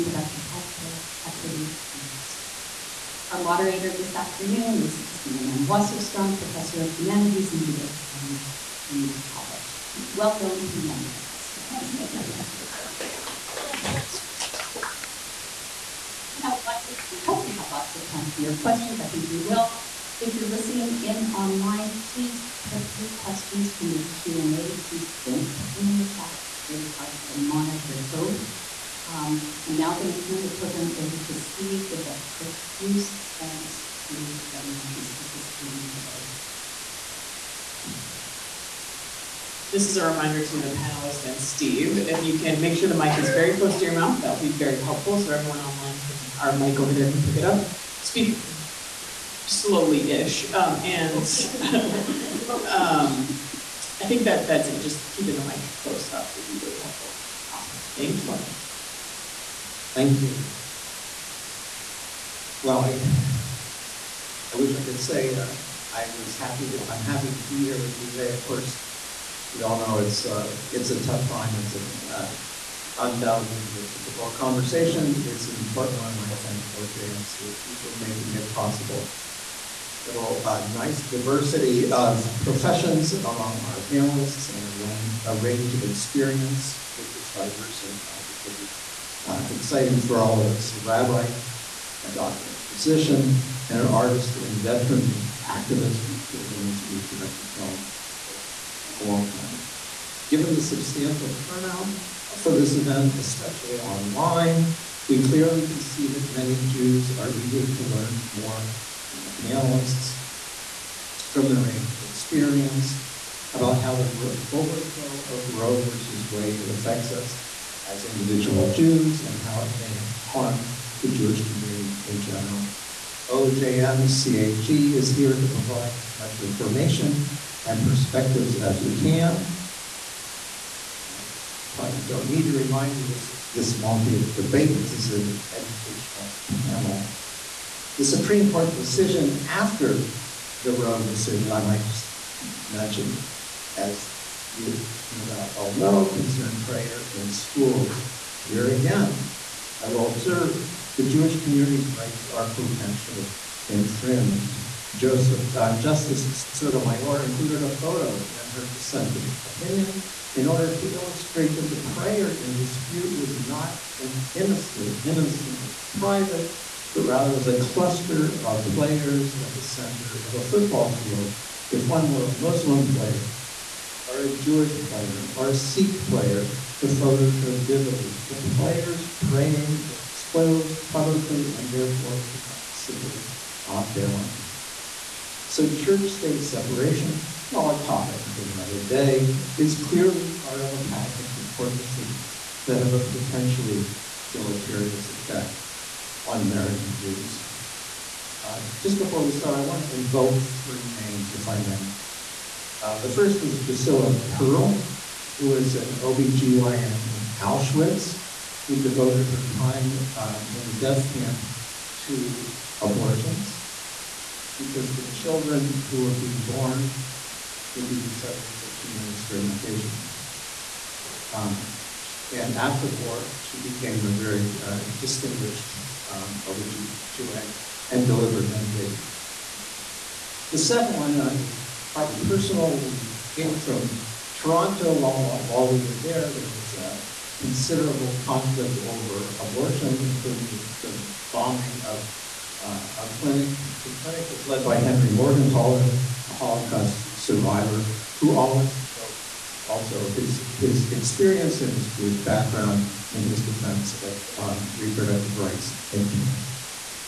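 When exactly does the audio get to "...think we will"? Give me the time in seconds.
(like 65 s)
19 s.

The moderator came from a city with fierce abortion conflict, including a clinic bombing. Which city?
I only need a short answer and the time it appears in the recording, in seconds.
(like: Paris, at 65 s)
Toronto, at 234 s.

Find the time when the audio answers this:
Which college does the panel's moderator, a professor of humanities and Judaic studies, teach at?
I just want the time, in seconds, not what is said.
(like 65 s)
8 s.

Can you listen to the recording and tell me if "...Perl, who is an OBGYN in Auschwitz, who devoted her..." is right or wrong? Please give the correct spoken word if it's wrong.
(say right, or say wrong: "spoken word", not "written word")
right.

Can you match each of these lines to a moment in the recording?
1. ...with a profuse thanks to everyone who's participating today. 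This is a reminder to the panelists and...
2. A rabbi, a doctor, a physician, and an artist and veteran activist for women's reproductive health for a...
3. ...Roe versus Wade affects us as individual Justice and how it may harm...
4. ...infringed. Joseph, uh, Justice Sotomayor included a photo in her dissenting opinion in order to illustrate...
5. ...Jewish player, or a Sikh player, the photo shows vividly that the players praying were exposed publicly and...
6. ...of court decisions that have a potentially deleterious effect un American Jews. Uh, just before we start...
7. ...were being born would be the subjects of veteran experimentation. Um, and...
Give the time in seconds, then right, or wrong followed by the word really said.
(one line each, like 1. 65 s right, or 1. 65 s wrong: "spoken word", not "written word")
1. 31 s right
2. 90 s right
3. 115 s wrong: "Jews", not "Justice"
4. 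153 s right
5. 174 s right
6. 191 s right
7. 216 s wrong: "human", not "veteran".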